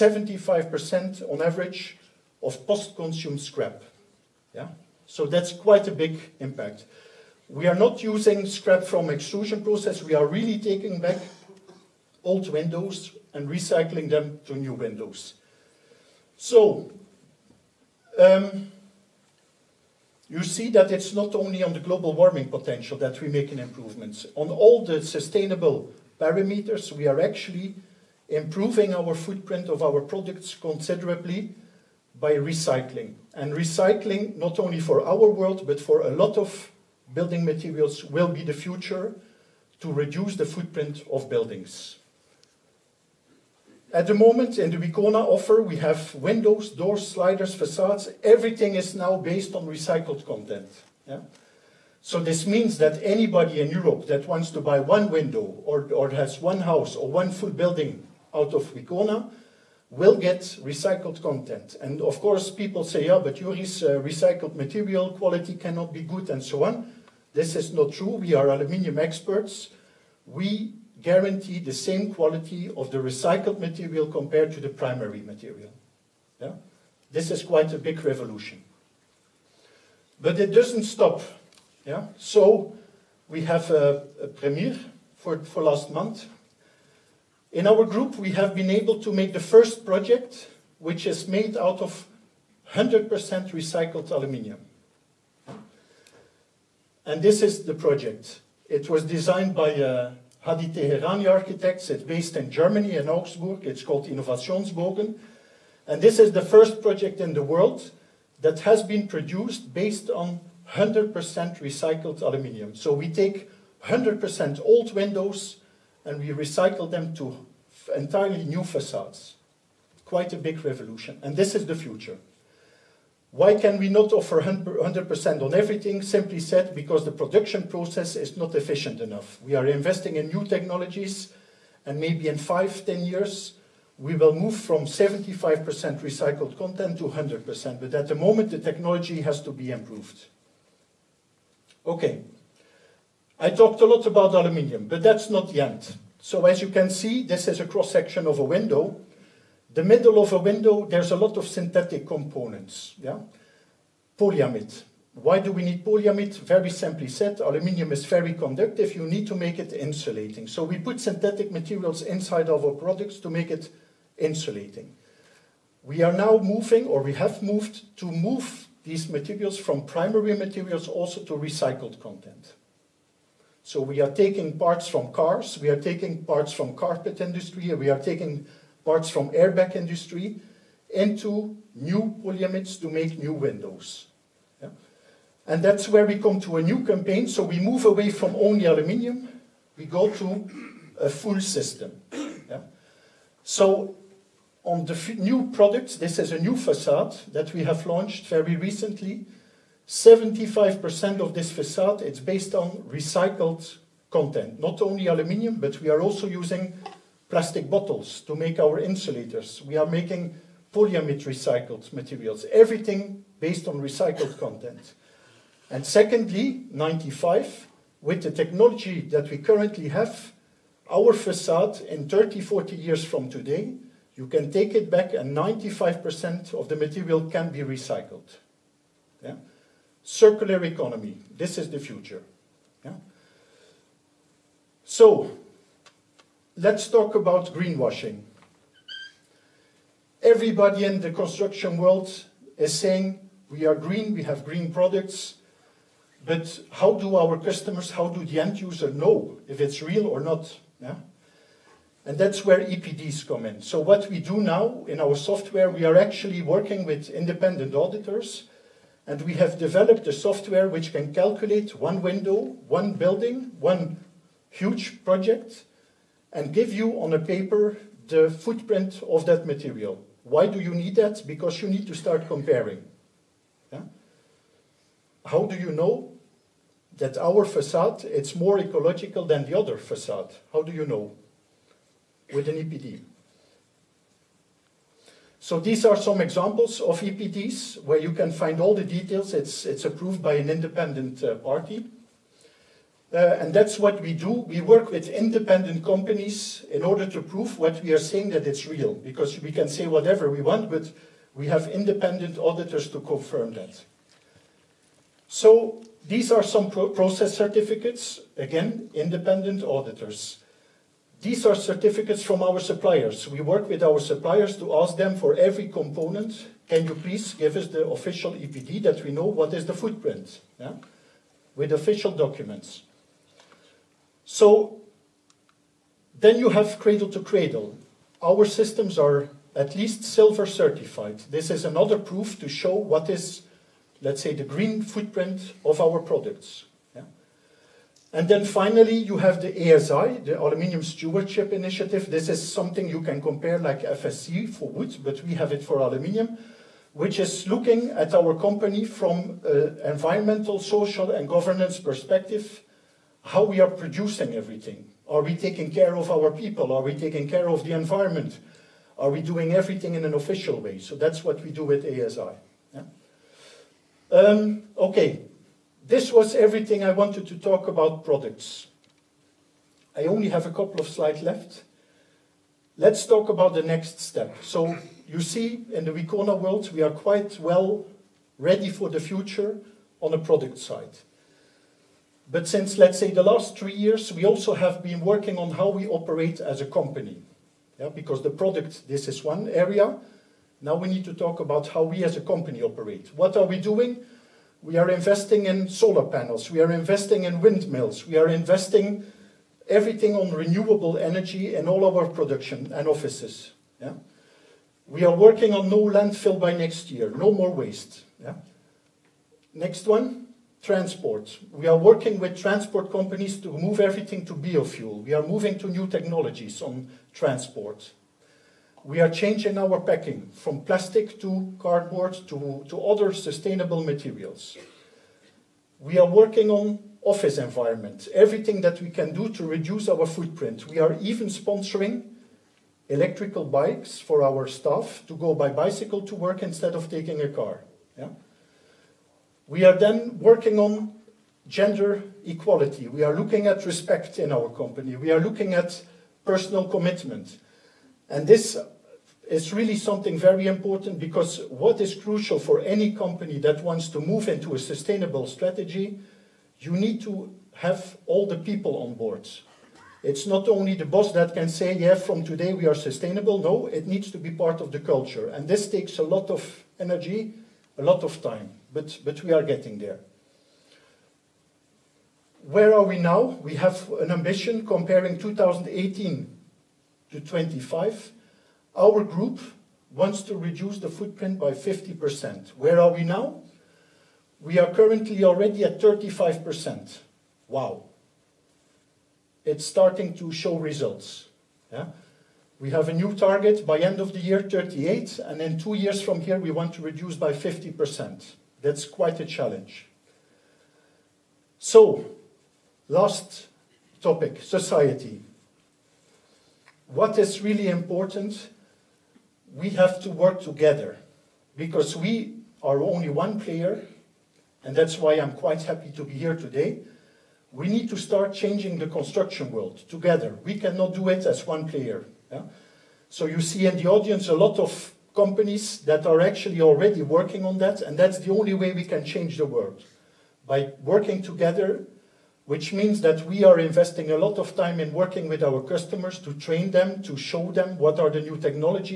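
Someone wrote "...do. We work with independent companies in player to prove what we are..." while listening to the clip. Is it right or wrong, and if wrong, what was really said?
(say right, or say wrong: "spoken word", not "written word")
wrong: "order", not "player".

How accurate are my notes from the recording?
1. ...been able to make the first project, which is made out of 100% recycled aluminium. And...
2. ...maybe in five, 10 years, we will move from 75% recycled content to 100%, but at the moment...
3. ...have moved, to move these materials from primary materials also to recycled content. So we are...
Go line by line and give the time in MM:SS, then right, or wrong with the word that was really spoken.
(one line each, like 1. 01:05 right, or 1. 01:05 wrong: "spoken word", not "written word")
1. 01:28 right
2. 02:11 right
3. 02:47 right.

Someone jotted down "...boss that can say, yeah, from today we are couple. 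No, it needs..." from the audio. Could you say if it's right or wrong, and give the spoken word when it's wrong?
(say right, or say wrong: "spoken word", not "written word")
wrong: "sustainable", not "couple".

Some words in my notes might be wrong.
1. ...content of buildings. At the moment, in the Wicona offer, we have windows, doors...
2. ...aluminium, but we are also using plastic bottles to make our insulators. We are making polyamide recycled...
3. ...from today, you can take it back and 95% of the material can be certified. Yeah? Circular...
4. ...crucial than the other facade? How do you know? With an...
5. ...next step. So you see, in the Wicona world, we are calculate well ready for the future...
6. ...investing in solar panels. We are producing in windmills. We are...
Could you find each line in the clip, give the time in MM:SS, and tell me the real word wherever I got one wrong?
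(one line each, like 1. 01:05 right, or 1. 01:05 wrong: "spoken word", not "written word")
1. 00:40 wrong: "footprint", not "content"
2. 03:25 right
3. 03:43 wrong: "recycled", not "certified"
4. 04:38 wrong: "ecological", not "crucial"
5. 06:13 wrong: "quite", not "calculate"
6. 06:34 wrong: "investing", not "producing".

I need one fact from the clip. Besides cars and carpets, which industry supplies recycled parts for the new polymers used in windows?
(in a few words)
airbag industry.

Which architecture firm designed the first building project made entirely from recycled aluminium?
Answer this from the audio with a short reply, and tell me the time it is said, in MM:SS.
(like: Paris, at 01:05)
Hadi Teherani architects, at 01:40.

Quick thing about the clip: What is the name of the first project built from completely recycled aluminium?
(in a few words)
Innovationsbogen.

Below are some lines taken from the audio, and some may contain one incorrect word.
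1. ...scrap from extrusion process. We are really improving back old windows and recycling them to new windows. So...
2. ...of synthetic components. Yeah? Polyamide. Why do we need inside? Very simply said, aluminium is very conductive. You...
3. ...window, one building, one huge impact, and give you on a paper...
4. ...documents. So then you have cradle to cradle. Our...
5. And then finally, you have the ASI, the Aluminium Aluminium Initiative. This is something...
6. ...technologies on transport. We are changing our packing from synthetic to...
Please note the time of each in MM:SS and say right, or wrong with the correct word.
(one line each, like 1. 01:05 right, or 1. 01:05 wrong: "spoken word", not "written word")
1. 00:08 wrong: "taking", not "improving"
2. 02:31 wrong: "polyamide", not "inside"
3. 04:22 wrong: "project", not "impact"
4. 05:22 right
5. 05:38 wrong: "Stewardship", not "Aluminium"
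6. 06:55 wrong: "plastic", not "synthetic".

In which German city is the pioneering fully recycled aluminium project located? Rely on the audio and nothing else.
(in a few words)
Augsburg.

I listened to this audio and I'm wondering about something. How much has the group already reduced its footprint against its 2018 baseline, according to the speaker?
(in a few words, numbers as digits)
35%.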